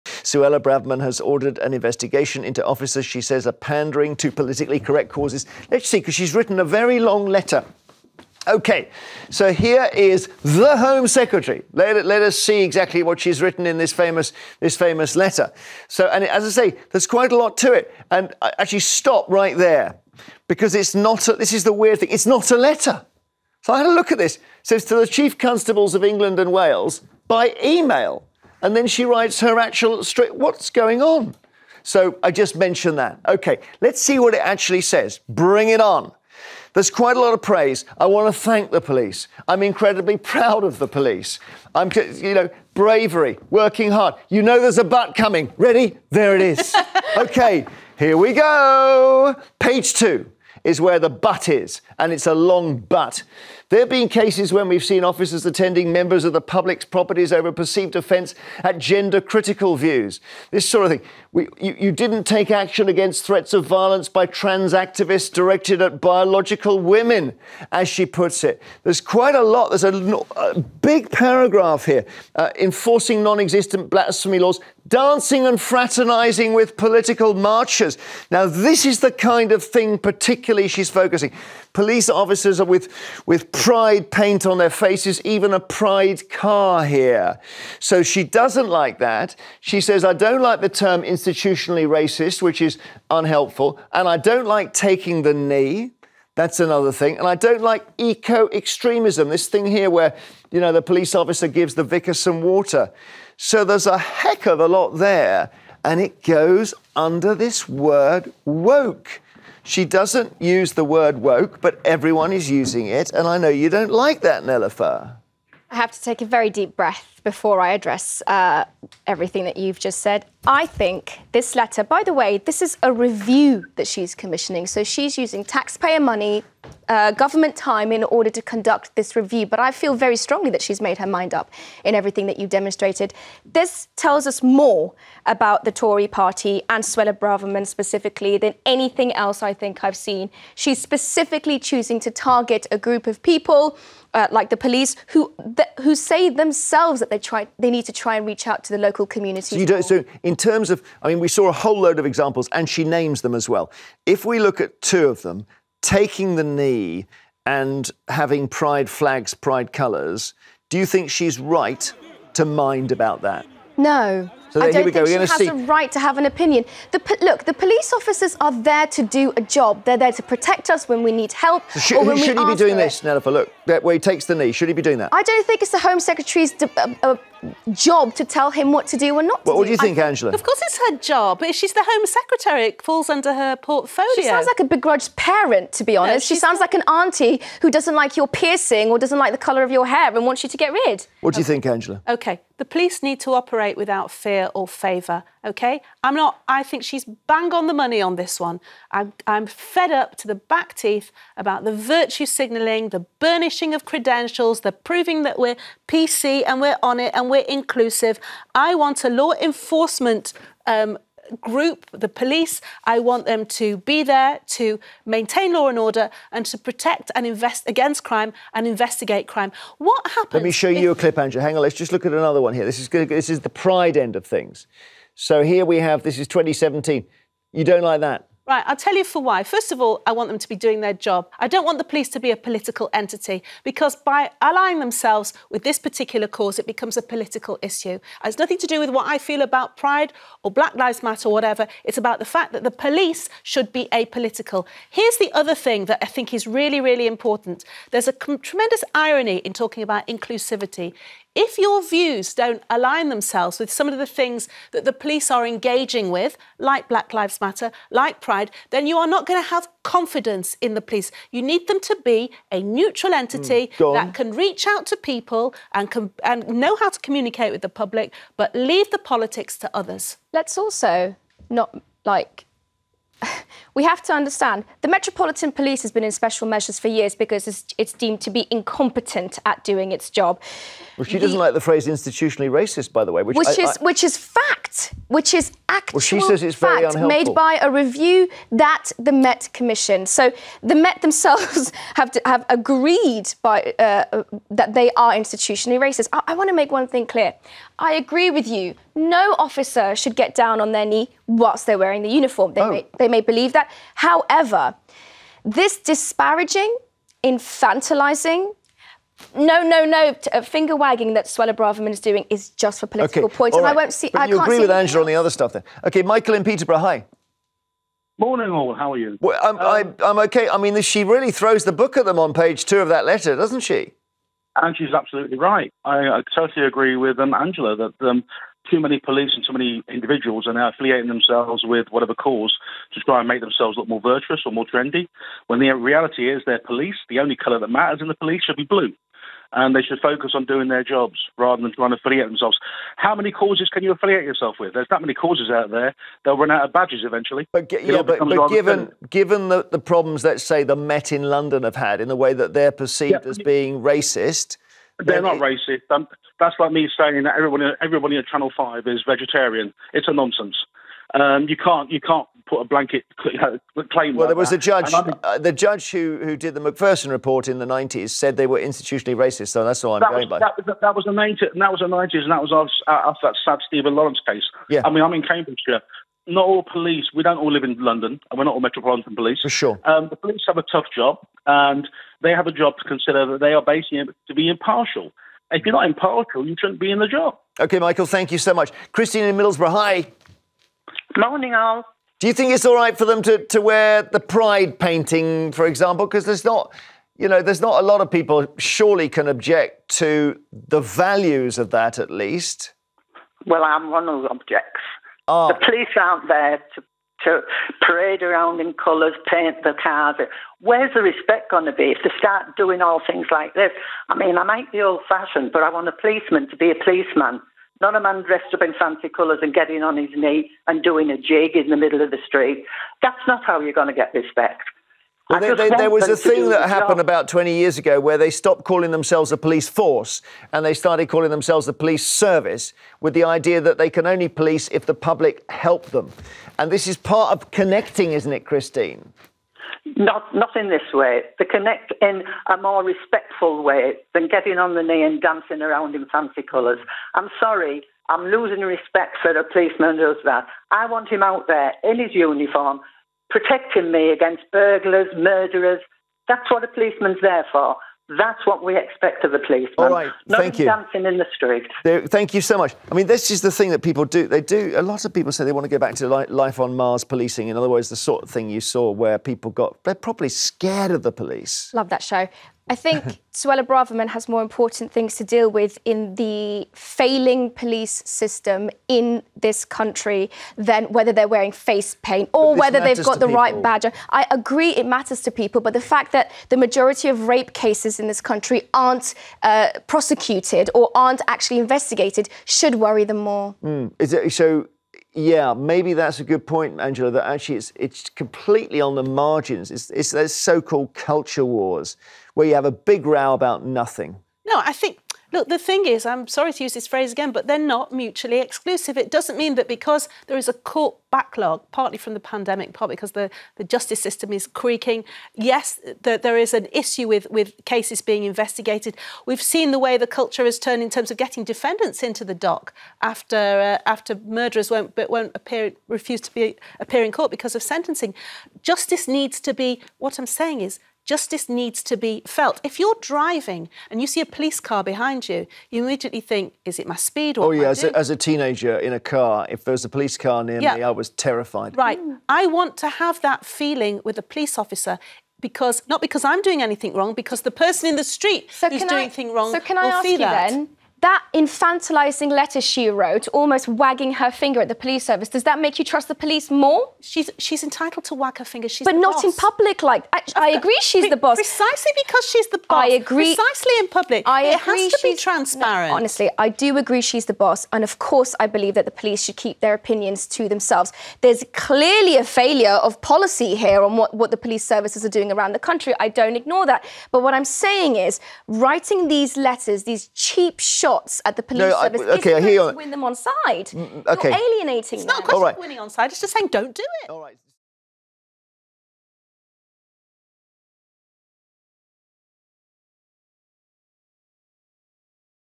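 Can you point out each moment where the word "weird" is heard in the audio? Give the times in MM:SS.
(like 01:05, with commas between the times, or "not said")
00:21.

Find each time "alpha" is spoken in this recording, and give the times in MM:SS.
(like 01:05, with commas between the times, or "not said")
not said.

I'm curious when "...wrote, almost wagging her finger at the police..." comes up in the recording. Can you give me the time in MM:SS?
09:12.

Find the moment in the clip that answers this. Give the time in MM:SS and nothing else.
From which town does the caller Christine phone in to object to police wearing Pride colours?
06:29.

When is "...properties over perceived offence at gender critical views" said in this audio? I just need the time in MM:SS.
00:56.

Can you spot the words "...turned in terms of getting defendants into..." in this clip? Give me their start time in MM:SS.
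08:40.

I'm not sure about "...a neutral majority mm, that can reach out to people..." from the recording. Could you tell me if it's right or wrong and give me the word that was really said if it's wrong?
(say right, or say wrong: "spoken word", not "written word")
wrong: "entity", not "majority".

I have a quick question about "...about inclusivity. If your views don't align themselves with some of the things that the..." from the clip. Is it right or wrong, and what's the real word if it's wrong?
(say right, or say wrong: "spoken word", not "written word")
right.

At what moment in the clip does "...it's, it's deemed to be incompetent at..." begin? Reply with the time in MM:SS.
04:37.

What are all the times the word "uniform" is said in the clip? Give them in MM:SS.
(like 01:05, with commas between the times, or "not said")
05:02, 07:32.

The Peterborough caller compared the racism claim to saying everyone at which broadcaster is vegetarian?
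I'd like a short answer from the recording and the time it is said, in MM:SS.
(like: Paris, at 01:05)
Channel Five, at 05:58.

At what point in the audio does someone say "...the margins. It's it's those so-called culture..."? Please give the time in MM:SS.
08:18.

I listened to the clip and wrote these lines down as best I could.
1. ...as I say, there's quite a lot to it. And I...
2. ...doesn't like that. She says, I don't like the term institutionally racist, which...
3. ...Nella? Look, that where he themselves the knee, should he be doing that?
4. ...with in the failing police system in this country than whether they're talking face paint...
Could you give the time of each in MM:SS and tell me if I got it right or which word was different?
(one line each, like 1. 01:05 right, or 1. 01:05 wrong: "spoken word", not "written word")
1. 00:16 right
2. 01:28 right
3. 02:53 wrong: "takes", not "themselves"
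4. 07:55 wrong: "wearing", not "talking".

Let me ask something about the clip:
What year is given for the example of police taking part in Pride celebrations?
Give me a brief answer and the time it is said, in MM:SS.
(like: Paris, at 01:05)
2017, at 03:46.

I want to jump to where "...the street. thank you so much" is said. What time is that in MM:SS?
07:41.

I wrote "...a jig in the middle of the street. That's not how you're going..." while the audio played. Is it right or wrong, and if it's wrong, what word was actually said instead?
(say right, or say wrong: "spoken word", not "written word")
right.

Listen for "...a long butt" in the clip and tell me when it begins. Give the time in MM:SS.
00:52.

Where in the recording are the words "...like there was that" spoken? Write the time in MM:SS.
06:04.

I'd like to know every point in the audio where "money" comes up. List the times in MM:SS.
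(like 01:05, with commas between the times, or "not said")
02:05, 03:17.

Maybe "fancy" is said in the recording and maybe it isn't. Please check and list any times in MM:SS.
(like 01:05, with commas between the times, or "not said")
06:58, 07:26.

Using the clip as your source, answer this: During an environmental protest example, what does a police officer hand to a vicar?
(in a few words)
Water.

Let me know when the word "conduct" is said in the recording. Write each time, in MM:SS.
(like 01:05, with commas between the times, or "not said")
02:08.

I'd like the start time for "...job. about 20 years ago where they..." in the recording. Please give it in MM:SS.
07:06.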